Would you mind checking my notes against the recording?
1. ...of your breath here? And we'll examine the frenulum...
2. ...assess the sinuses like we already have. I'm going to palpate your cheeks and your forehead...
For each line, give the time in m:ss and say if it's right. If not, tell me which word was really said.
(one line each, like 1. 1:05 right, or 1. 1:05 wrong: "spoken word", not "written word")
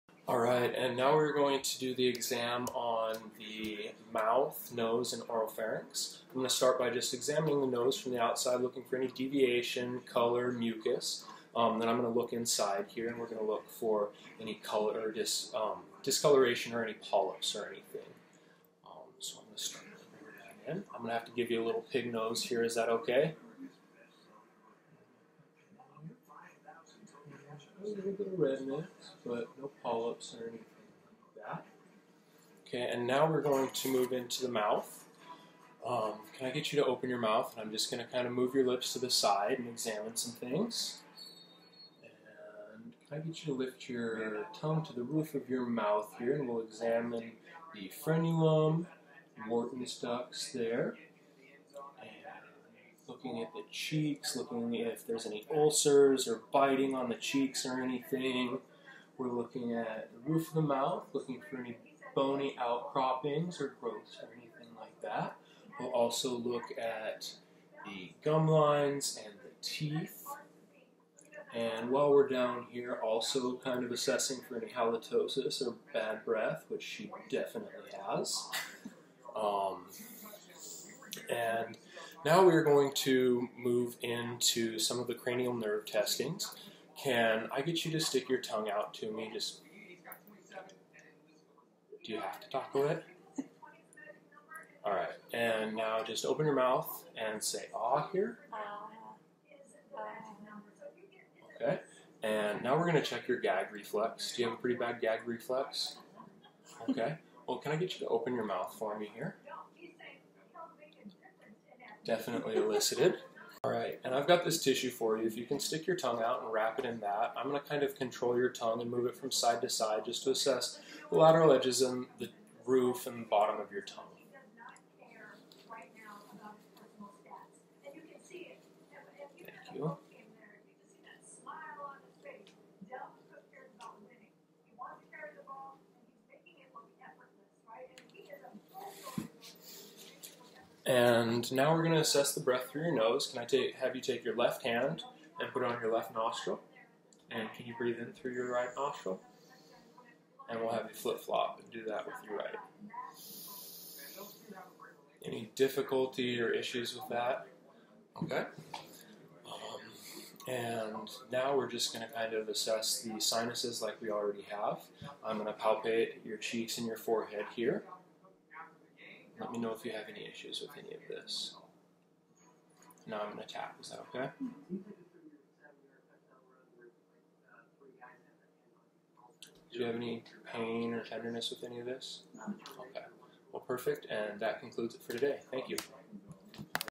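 1. 0:45 wrong: "mouth", not "breath"
2. 2:42 right.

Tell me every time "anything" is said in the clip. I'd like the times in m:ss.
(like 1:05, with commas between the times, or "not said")
0:17, 0:30, 0:57, 1:04.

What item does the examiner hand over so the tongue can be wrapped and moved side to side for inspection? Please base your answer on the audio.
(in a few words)
tissue.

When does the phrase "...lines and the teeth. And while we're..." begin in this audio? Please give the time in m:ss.
1:08.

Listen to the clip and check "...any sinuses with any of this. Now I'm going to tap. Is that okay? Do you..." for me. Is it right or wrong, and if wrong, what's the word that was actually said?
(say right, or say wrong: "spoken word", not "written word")
wrong: "issues", not "sinuses".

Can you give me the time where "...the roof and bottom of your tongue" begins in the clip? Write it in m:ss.
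2:02.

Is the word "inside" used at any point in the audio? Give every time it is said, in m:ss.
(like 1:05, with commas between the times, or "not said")
0:12.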